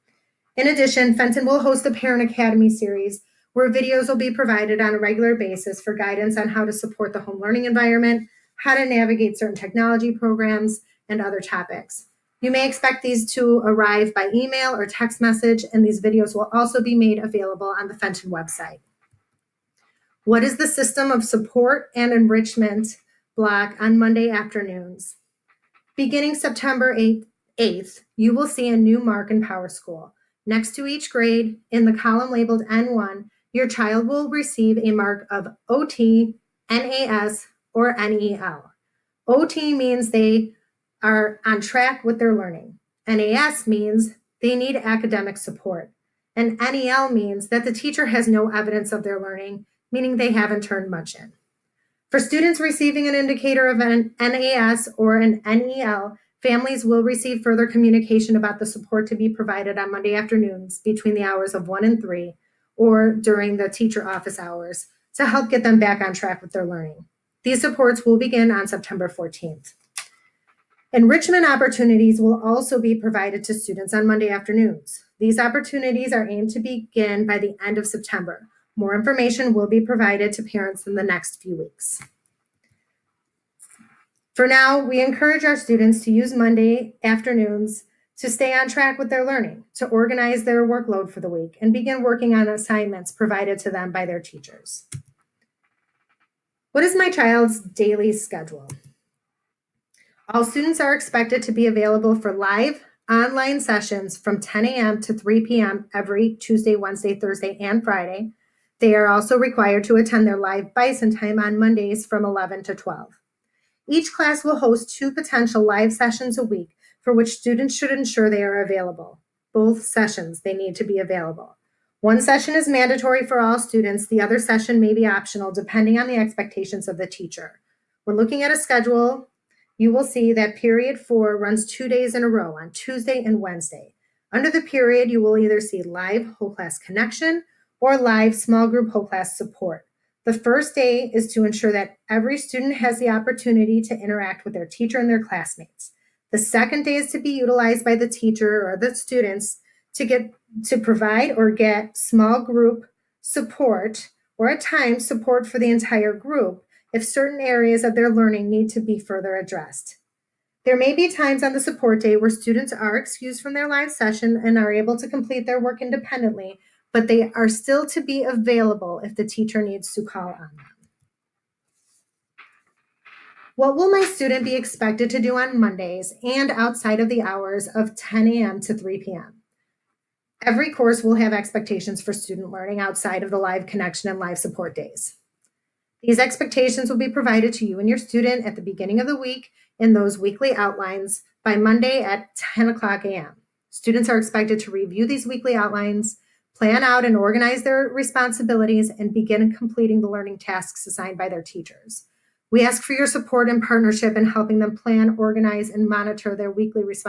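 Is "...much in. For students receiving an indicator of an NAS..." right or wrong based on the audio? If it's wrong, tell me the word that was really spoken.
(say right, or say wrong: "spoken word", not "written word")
right.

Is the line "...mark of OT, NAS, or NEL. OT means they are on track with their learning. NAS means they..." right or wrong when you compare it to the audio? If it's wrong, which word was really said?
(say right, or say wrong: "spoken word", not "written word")
right.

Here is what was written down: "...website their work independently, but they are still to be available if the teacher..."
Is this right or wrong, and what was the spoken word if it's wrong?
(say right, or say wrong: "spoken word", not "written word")
wrong: "complete", not "website".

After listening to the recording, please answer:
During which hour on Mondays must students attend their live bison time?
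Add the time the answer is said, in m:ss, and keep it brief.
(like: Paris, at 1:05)
11 to 12, at 1:52.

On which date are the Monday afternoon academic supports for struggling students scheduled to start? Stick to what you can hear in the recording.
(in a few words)
September 14th.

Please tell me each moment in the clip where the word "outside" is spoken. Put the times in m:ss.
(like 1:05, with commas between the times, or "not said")
2:56, 3:02.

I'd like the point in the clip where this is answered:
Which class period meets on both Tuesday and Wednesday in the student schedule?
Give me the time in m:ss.
2:10.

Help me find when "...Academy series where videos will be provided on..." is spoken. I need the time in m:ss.
0:02.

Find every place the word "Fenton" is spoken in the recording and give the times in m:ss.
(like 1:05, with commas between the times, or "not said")
0:01, 0:17.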